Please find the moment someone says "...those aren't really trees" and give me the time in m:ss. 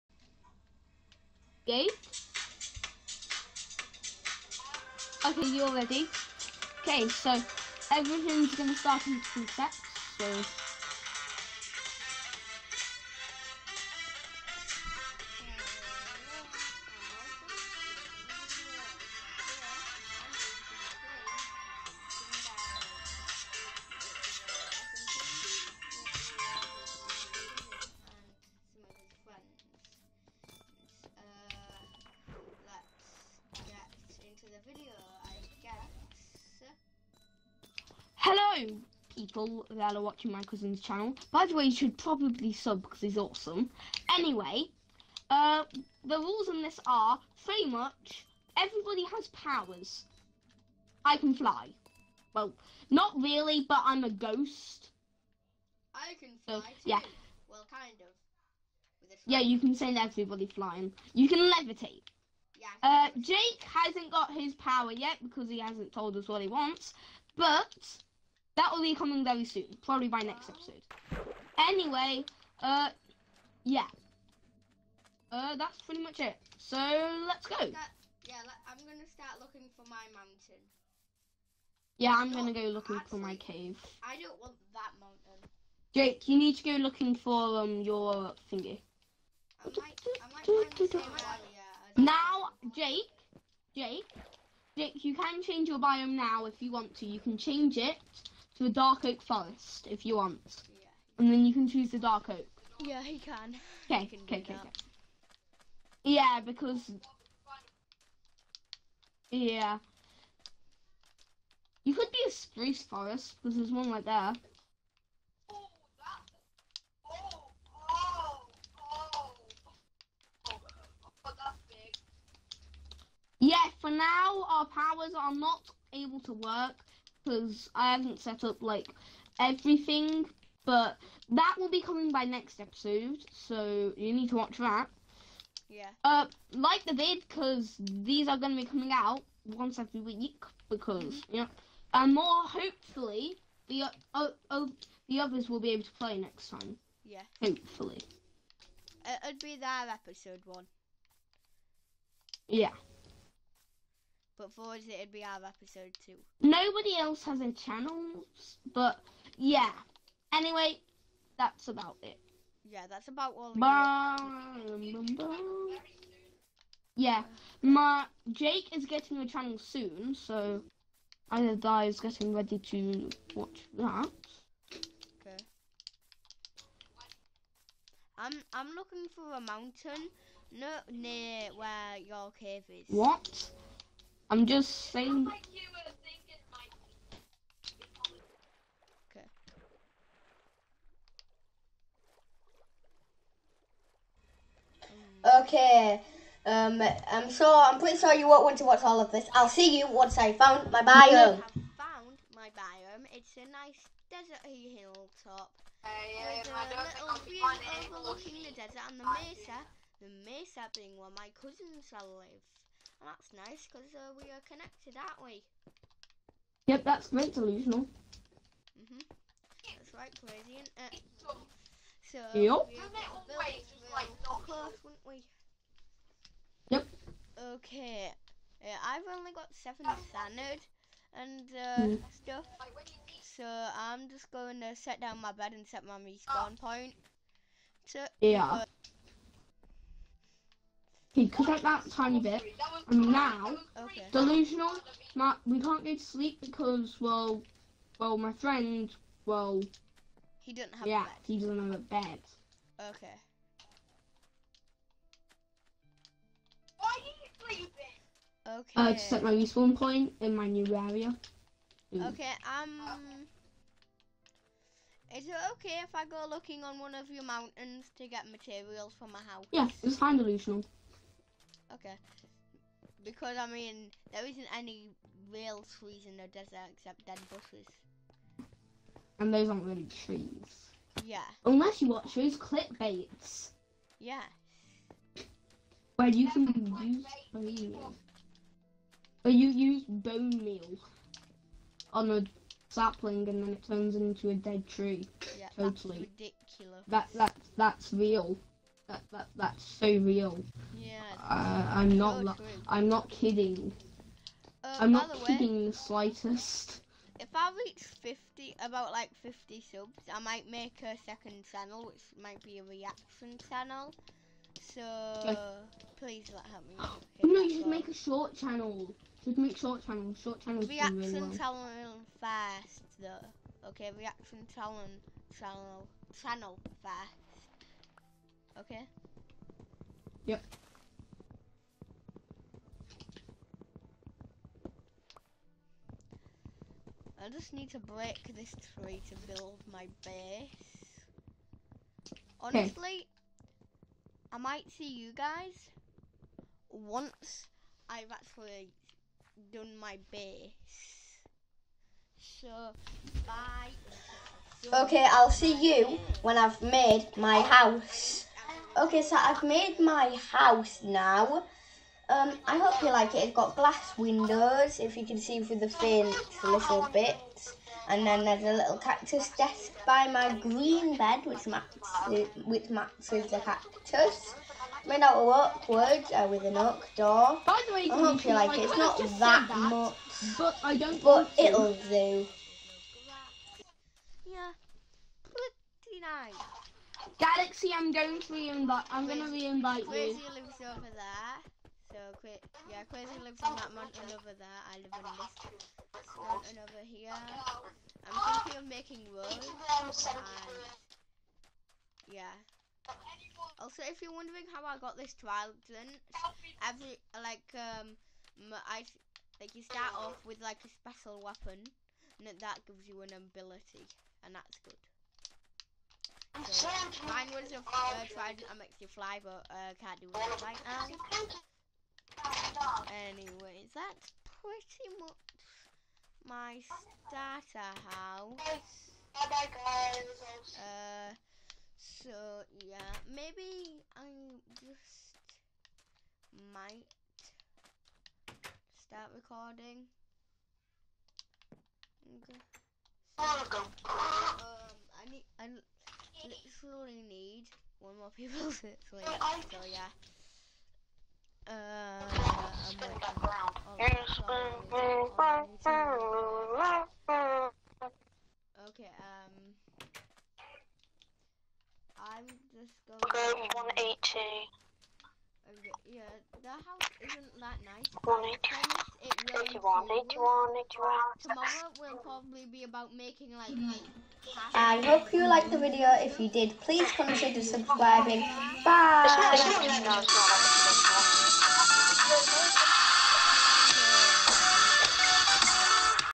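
4:39.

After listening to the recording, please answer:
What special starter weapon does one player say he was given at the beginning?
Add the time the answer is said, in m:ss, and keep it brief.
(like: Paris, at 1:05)
Trident, at 6:45.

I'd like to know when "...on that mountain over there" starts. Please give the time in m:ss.
6:33.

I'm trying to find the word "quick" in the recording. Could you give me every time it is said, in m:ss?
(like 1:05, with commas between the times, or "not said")
6:32.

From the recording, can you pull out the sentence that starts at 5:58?
Okay, so I've made my house now.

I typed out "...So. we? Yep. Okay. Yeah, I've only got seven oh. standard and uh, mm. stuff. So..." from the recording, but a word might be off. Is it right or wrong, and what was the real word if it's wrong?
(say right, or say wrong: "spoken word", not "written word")
right.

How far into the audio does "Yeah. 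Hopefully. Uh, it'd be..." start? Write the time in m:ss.
2:27.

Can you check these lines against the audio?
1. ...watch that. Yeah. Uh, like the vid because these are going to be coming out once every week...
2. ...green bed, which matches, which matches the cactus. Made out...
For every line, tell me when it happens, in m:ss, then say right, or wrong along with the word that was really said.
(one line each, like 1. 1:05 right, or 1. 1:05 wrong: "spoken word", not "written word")
1. 2:14 right
2. 6:10 right.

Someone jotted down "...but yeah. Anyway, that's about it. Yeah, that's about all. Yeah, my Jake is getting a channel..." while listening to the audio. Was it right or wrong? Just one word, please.
right.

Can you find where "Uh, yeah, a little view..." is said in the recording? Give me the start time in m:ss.
3:25.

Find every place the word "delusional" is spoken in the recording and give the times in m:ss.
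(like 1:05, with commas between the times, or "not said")
3:37, 4:04, 4:30.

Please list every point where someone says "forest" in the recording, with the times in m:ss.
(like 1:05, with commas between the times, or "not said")
1:39, 1:52.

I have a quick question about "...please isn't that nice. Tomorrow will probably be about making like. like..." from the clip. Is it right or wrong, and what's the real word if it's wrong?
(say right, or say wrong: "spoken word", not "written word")
wrong: "house", not "please".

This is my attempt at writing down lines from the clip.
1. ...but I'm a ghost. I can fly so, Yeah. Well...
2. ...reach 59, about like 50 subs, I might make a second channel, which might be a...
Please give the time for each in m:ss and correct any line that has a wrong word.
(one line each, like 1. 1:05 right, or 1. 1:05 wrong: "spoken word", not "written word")
1. 0:53 right
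2. 5:07 wrong: "50", not "59".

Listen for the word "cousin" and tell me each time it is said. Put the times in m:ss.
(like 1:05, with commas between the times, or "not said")
0:40, 3:31.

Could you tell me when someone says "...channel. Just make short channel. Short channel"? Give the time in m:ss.
5:18.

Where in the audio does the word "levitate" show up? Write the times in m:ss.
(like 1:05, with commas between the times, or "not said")
1:01.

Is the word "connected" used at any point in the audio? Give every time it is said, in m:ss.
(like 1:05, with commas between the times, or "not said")
3:34.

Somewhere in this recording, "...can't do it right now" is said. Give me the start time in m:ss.
6:59.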